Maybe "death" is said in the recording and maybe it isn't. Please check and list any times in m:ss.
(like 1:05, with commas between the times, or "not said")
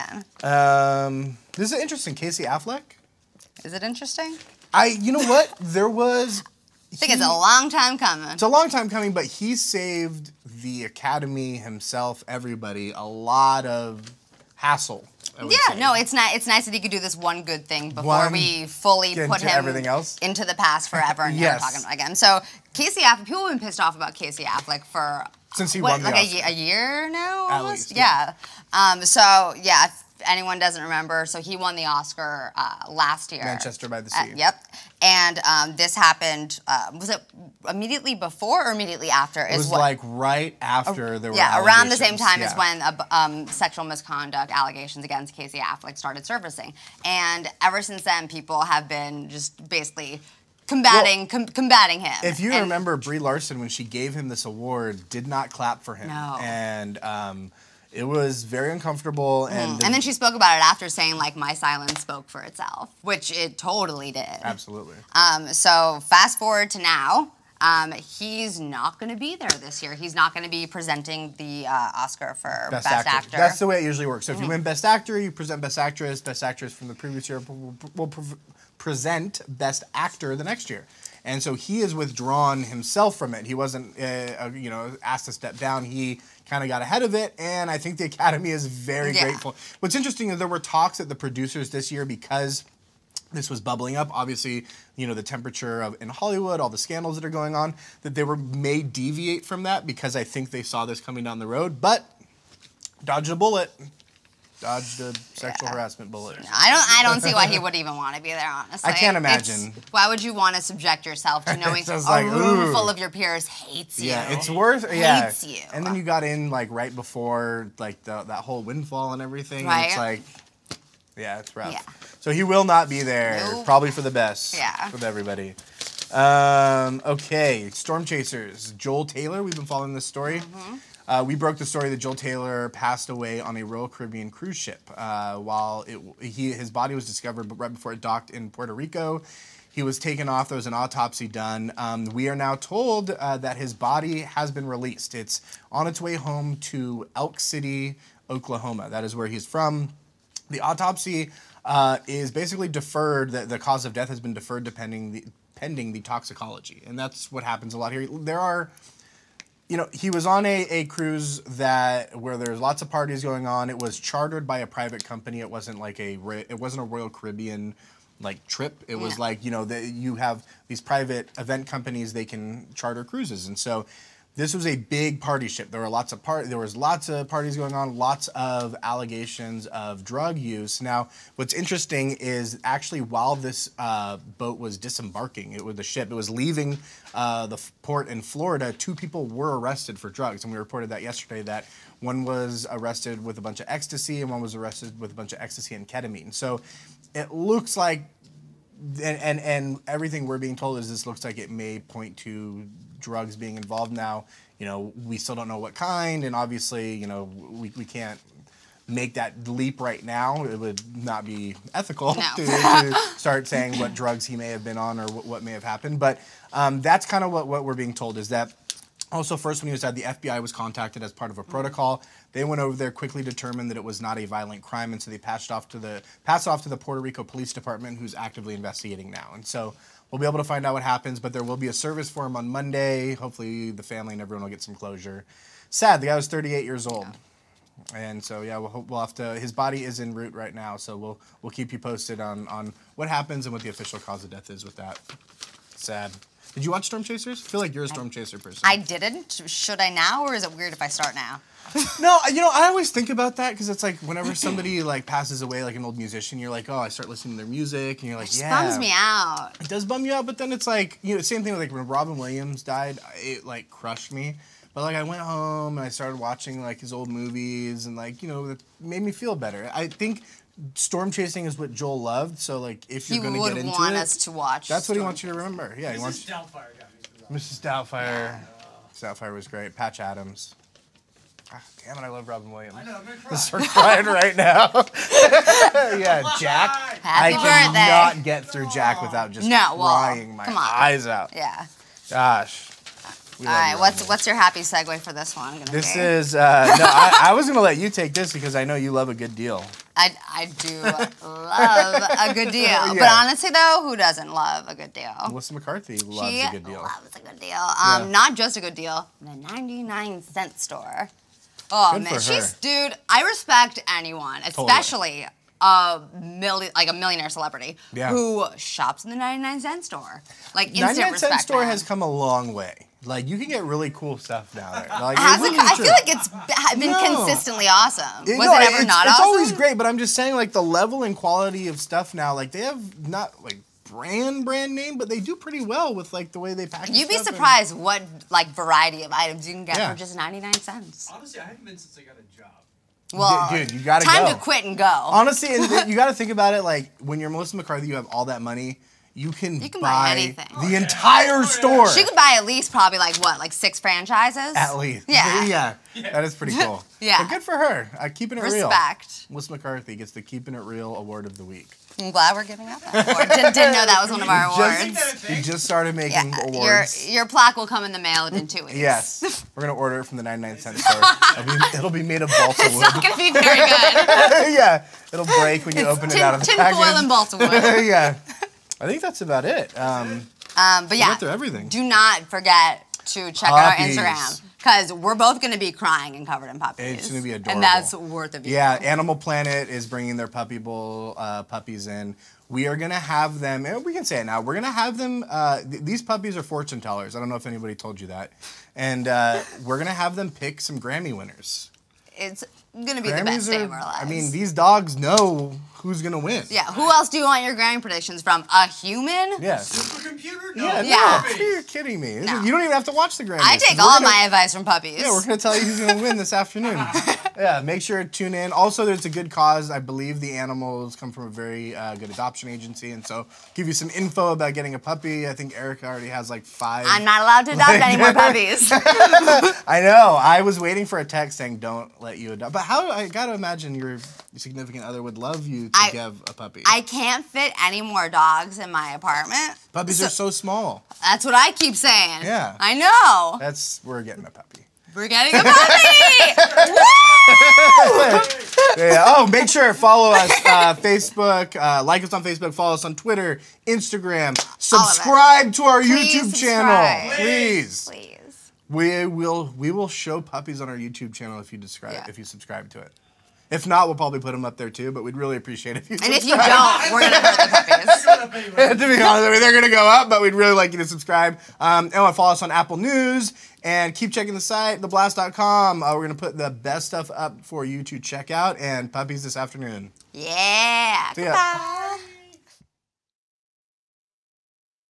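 2:33, 4:04.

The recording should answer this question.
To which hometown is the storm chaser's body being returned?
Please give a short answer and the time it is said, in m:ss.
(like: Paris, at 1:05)
Elk City, Oklahoma, at 2:27.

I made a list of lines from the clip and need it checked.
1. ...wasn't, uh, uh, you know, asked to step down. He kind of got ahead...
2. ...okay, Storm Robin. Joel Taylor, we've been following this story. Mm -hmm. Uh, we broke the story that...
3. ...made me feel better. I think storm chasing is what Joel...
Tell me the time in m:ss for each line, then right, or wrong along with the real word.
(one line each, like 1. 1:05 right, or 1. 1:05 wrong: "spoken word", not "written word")
1. 1:23 right
2. 2:07 wrong: "Chasers", not "Robin"
3. 4:28 right.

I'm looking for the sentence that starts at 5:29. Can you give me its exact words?
It's always great, but I'm just saying like the level and quality of stuff now.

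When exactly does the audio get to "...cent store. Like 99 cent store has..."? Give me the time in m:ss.
5:19.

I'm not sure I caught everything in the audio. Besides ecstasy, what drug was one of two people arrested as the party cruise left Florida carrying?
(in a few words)
ketamine.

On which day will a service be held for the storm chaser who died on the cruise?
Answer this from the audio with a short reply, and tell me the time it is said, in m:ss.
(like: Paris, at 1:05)
Monday, at 3:52.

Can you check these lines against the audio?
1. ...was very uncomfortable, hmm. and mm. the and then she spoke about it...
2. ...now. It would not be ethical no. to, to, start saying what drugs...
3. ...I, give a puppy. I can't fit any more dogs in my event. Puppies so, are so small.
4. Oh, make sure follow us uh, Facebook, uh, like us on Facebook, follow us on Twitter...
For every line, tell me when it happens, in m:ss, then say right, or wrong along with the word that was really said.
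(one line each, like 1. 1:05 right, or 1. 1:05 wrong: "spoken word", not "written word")
1. 0:58 right
2. 3:30 right
3. 7:15 wrong: "apartment", not "event"
4. 7:29 right.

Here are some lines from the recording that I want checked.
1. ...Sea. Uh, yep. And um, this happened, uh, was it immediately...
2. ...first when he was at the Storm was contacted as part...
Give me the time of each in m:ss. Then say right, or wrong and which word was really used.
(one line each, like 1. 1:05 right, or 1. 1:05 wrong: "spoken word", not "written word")
1. 0:34 right
2. 3:39 wrong: "FBI", not "Storm".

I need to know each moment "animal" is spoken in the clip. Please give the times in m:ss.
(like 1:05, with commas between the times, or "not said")
6:28, 7:00.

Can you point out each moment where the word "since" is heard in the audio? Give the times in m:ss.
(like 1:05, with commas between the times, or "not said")
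0:25, 0:47, 5:41.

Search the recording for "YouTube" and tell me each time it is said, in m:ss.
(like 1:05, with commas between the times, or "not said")
7:36, 7:40.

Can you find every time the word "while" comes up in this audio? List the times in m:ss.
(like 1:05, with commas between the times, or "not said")
2:15, 3:03.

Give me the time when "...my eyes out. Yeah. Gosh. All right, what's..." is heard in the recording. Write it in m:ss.
4:50.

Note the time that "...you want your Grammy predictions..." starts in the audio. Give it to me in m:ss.
6:47.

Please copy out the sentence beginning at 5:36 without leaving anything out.
You'd be surprised and, what like variety of items you can get yeah.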